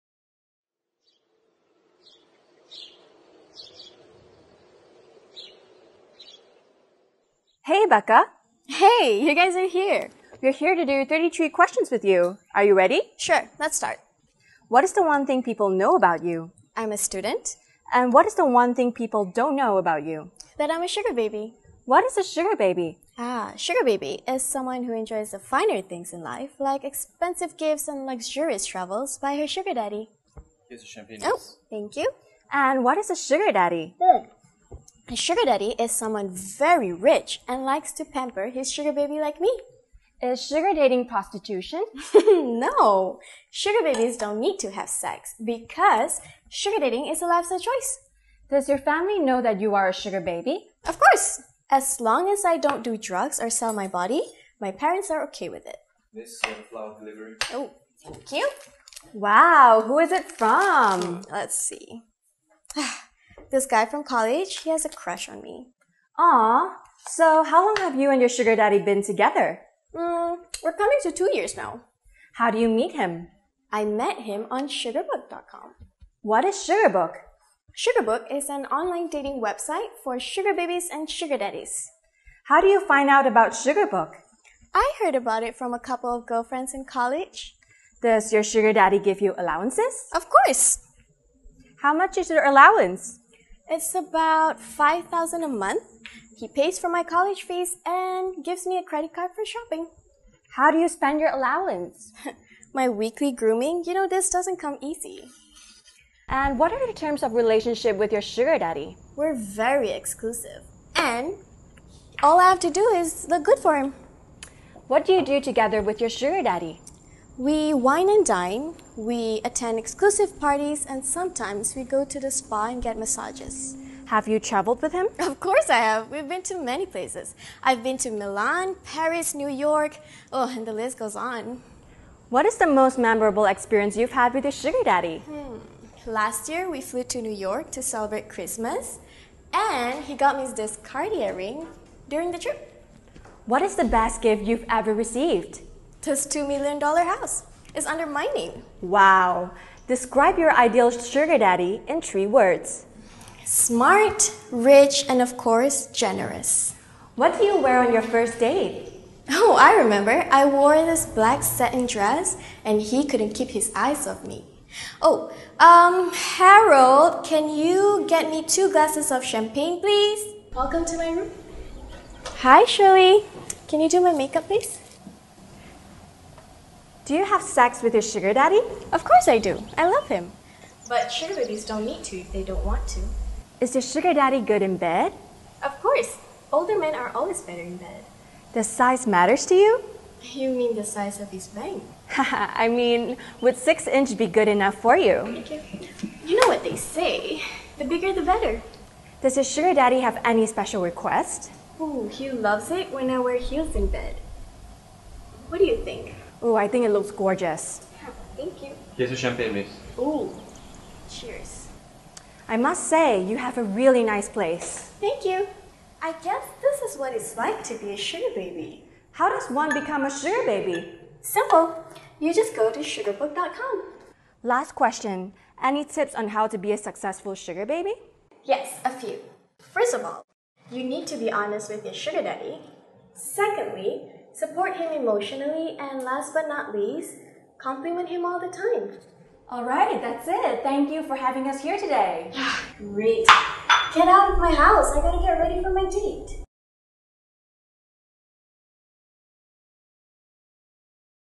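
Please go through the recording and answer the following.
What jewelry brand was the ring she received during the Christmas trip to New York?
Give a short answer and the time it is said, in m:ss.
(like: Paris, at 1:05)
Cartier, at 2:20.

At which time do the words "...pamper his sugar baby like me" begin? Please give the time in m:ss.
0:38.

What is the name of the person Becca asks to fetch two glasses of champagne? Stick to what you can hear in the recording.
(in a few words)
Harold.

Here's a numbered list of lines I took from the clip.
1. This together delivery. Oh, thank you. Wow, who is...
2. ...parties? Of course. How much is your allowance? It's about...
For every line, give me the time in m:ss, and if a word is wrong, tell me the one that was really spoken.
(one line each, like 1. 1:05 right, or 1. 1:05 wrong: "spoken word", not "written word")
1. 0:56 wrong: "flower", not "together"
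2. 1:29 wrong: "allowances", not "parties".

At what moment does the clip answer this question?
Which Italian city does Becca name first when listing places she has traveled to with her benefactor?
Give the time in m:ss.
2:08.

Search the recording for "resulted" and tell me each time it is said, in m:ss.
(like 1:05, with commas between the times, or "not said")
not said.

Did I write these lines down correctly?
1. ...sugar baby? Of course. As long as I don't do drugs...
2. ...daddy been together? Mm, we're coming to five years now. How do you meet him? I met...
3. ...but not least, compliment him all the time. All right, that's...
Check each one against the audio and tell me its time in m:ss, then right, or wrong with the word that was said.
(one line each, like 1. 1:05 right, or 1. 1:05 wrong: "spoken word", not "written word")
1. 0:49 right
2. 1:08 wrong: "two", not "five"
3. 3:56 right.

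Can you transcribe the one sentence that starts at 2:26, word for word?
This $2 million house is undermining.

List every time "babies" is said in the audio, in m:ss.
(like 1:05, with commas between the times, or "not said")
0:43, 1:20, 3:01.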